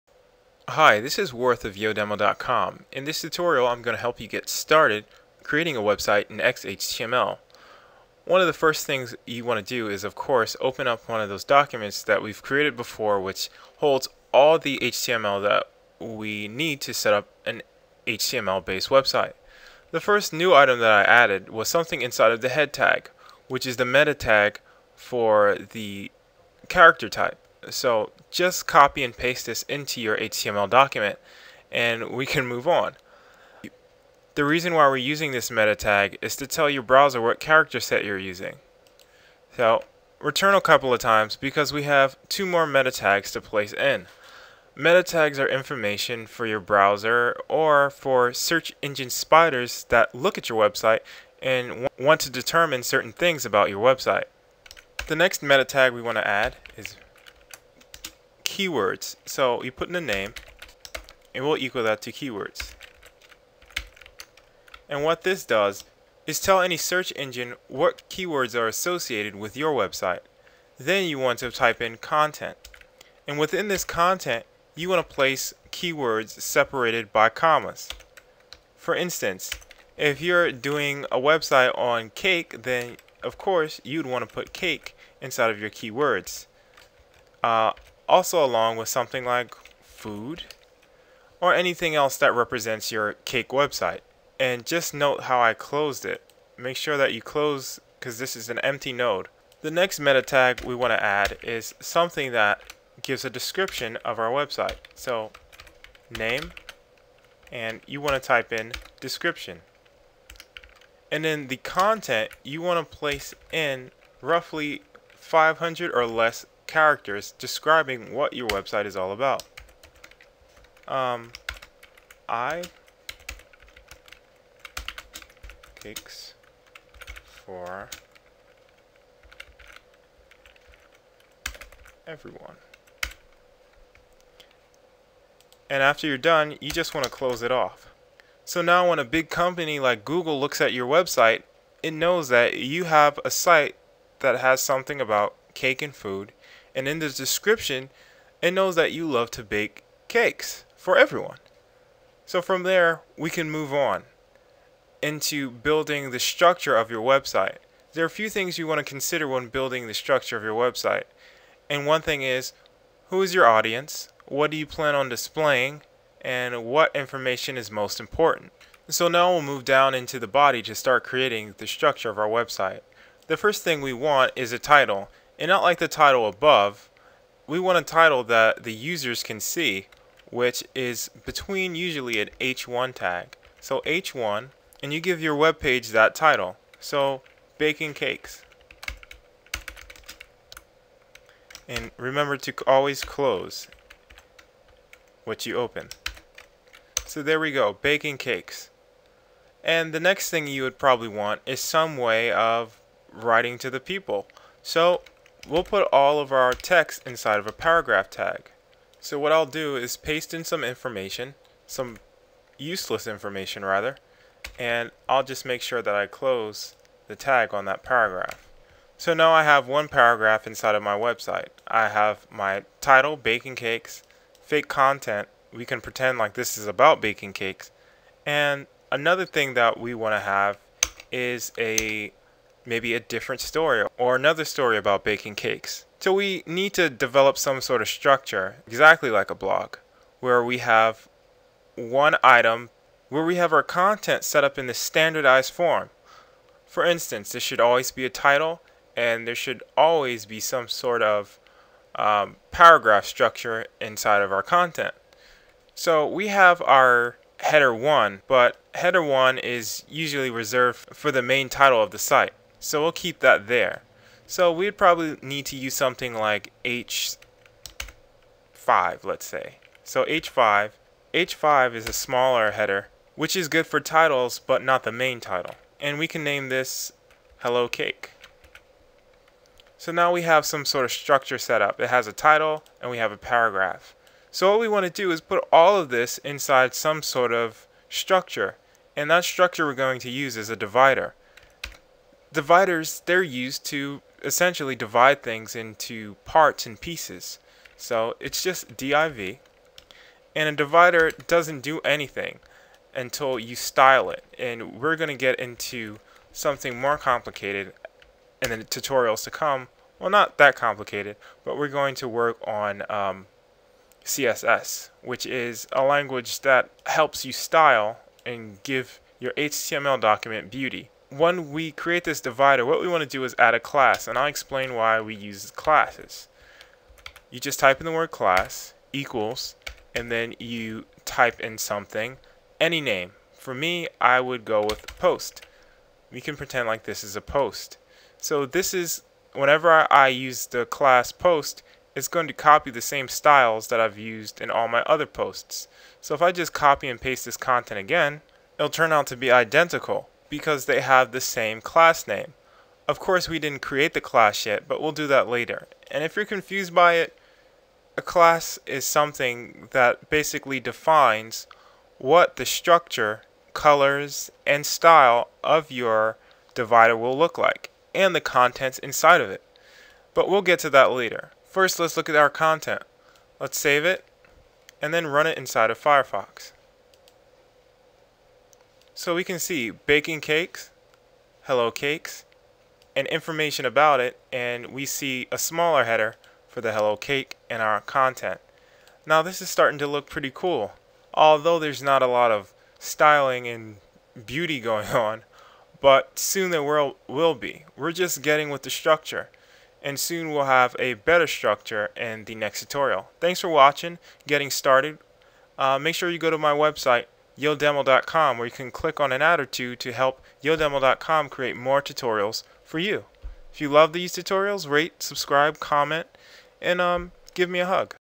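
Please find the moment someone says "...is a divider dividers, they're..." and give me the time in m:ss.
4:50.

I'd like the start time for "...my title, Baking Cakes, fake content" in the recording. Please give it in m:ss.
3:42.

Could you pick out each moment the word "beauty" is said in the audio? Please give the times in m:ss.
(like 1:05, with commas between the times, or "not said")
5:20, 6:34.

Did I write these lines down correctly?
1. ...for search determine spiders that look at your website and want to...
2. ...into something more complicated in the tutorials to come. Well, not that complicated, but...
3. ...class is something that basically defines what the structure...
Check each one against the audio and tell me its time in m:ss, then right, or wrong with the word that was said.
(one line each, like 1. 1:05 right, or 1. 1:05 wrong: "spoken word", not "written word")
1. 0:47 wrong: "engine", not "determine"
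2. 5:05 right
3. 5:58 right.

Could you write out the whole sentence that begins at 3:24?
So We'll put all of our text inside of a paragraph tag.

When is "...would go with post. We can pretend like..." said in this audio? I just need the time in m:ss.
5:34.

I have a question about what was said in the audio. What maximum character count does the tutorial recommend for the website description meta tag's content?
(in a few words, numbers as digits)
500.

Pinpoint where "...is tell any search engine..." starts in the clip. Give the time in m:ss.
1:06.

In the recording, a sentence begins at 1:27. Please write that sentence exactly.
Uh, also along with something like food or anything else that represents your cake website.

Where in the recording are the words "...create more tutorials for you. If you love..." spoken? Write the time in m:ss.
6:51.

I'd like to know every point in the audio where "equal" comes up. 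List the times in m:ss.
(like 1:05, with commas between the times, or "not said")
1:01, 5:28.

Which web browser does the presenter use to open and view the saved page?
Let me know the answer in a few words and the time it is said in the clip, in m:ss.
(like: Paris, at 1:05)
Firefox, at 6:15.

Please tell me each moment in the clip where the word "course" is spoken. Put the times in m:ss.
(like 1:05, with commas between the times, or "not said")
0:10, 1:23, 5:52.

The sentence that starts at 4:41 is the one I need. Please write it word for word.
It has a title and we have a paragraph.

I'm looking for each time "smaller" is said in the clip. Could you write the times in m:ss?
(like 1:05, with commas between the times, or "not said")
4:31, 6:25.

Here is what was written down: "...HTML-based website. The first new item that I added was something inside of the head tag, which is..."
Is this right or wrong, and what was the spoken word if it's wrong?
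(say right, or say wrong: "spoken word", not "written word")
right.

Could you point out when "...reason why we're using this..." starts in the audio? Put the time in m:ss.
0:34.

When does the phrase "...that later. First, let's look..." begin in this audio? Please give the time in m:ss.
6:10.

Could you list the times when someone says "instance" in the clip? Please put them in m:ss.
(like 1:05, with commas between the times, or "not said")
1:18, 4:06.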